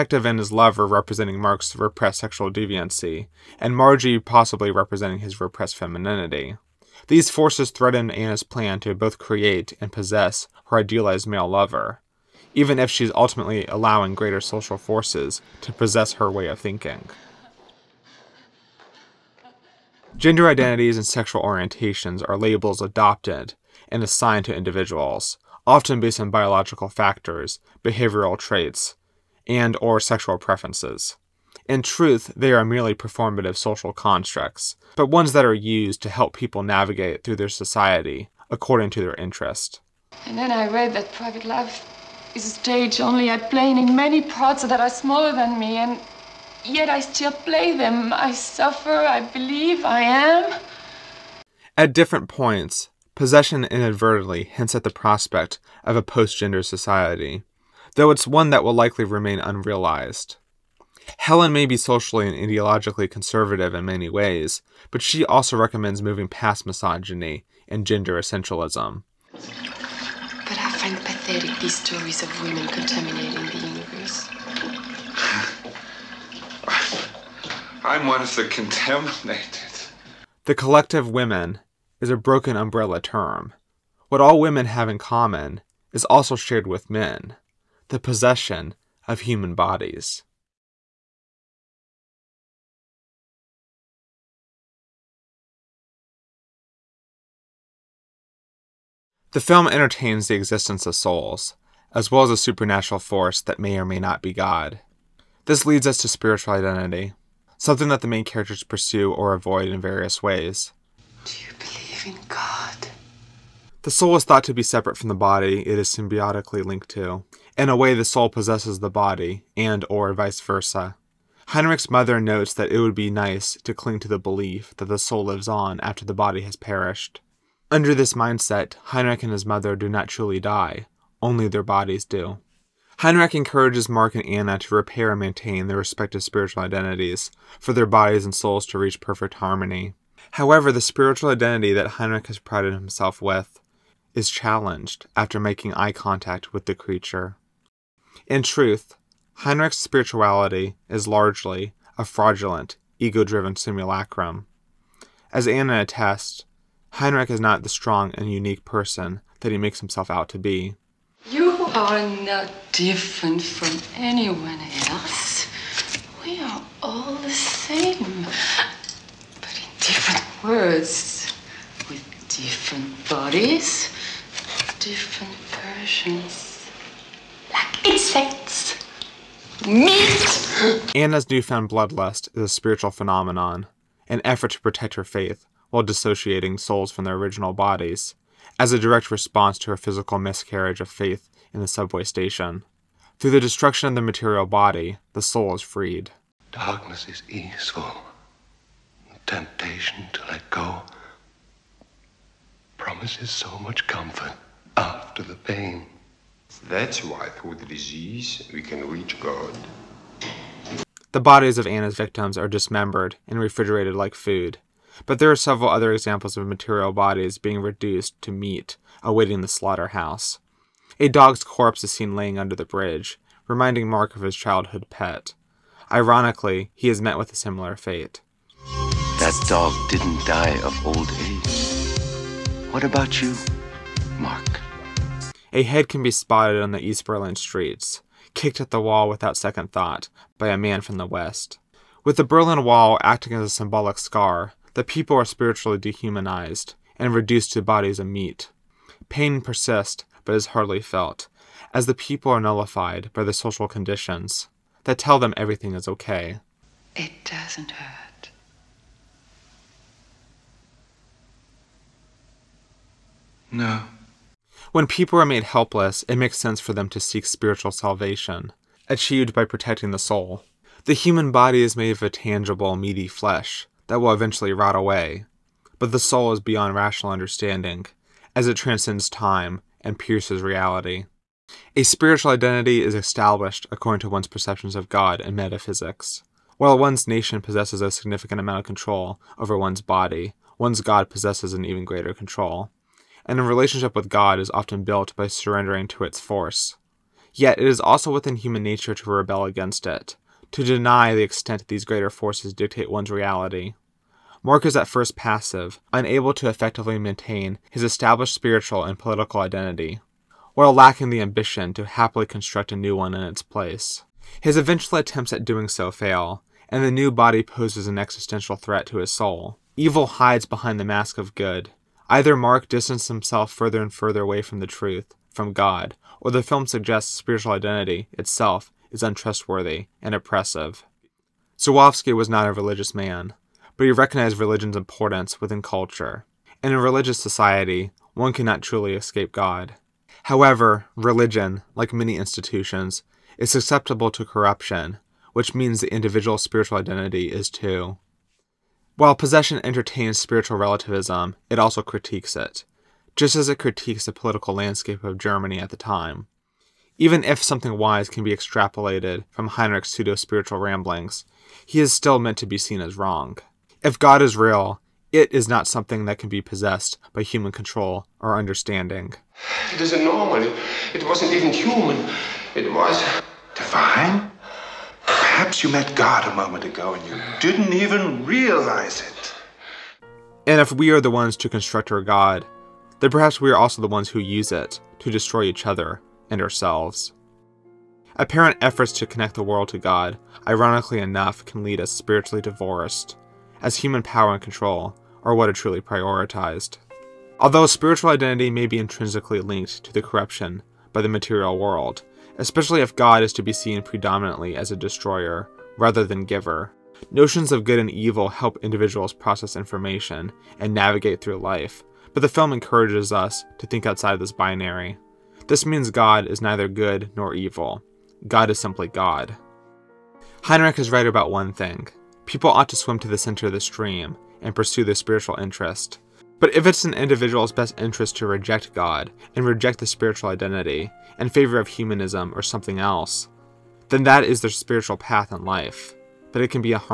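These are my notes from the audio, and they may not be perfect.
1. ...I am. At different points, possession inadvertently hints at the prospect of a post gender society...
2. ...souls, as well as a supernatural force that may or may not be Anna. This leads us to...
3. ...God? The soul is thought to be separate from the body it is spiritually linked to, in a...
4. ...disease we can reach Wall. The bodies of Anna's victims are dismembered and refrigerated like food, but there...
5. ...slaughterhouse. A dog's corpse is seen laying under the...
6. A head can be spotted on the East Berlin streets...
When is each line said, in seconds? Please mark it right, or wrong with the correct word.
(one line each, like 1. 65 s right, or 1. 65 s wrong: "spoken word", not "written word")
1. 49 s right
2. 100 s wrong: "God", not "Anna"
3. 112 s wrong: "symbiotically", not "spiritually"
4. 207 s wrong: "God", not "Wall"
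5. 219 s right
6. 235 s right.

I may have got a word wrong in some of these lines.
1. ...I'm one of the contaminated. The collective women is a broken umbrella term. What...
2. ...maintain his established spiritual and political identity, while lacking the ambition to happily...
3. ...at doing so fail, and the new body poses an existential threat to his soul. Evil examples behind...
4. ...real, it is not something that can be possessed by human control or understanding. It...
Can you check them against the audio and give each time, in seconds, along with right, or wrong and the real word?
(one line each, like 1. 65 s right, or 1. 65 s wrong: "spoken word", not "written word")
1. 77 s right
2. 306 s right
3. 315 s wrong: "hides", not "examples"
4. 364 s right.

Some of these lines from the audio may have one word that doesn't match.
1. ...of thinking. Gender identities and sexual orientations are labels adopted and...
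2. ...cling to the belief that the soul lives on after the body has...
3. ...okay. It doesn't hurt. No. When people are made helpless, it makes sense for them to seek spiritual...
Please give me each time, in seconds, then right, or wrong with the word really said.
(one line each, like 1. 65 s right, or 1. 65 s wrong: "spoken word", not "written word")
1. 16 s right
2. 123 s right
3. 255 s right.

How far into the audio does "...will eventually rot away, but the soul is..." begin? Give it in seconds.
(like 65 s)
274 s.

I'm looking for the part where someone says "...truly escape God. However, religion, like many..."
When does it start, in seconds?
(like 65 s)
338 s.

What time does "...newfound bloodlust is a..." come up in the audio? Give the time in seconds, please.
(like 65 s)
181 s.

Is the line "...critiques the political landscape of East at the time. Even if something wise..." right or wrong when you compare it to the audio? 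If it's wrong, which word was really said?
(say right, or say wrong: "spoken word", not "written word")
wrong: "Germany", not "East".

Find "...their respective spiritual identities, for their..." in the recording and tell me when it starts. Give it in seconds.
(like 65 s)
135 s.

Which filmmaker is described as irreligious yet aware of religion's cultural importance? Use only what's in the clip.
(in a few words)
Żuławski.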